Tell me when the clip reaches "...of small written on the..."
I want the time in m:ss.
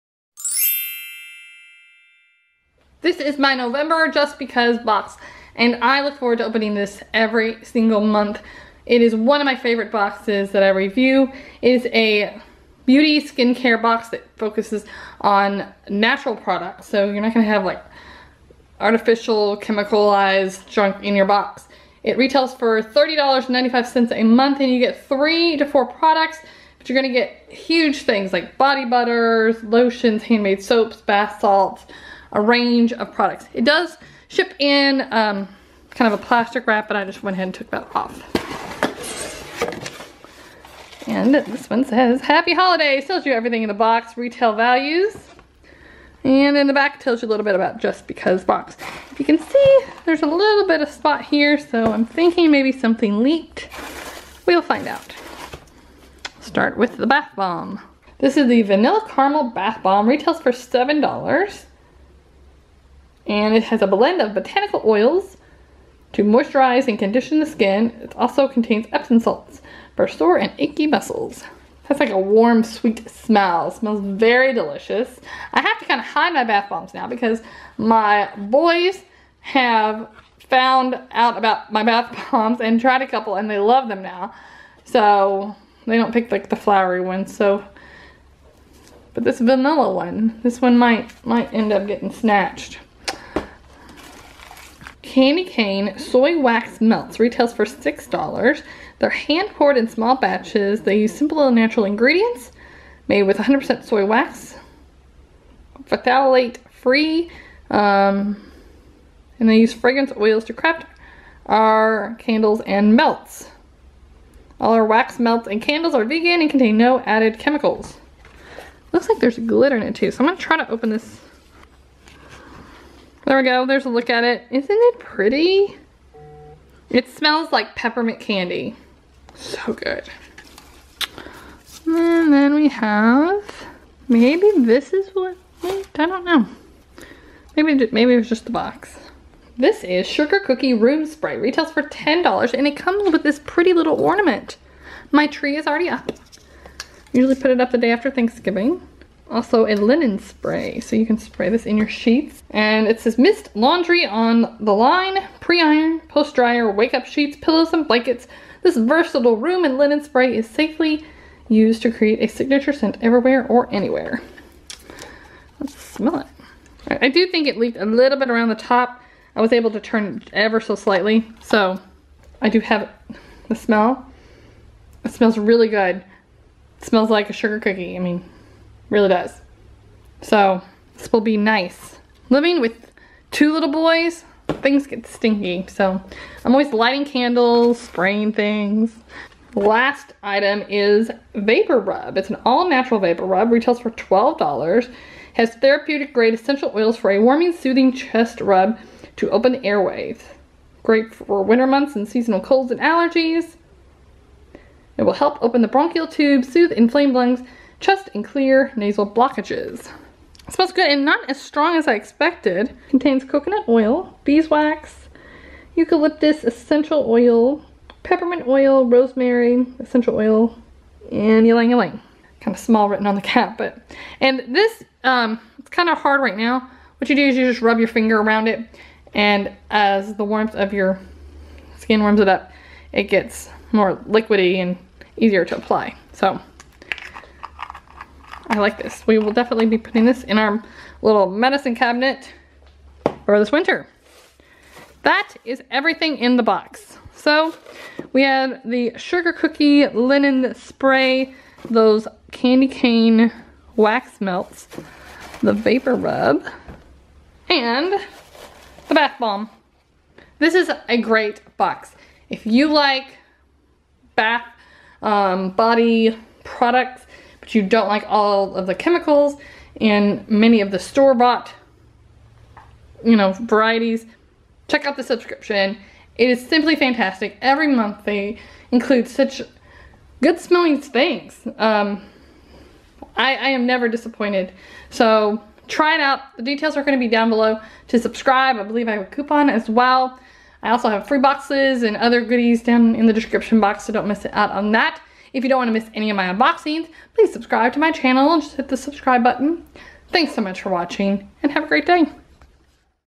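3:42.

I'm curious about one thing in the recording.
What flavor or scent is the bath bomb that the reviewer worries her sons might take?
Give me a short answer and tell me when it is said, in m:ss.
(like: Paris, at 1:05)
Vanilla Caramel, at 0:58.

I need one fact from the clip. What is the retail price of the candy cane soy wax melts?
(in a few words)
$6.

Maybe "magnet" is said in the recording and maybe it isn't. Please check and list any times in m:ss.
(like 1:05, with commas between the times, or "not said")
not said.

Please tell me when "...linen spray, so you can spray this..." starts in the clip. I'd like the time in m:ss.
2:29.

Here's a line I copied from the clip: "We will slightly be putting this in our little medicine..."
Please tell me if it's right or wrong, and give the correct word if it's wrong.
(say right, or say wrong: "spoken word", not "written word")
wrong: "definitely", not "slightly".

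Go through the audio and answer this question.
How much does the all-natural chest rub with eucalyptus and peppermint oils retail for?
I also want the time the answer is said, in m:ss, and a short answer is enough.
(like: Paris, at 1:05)
$12, at 3:13.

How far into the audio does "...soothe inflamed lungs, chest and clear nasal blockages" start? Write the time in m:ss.
3:26.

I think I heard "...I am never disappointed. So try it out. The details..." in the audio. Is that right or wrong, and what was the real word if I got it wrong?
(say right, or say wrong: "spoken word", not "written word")
right.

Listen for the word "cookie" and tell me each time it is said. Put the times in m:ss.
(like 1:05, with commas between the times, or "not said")
2:20, 2:57, 4:09.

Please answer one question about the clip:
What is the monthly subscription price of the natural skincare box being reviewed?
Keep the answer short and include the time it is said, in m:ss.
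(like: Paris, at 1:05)
$30.95, at 0:22.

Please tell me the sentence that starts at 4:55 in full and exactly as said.
If you don't want to miss any of my unboxings, please subscribe to my channel and just hit the subscribe button.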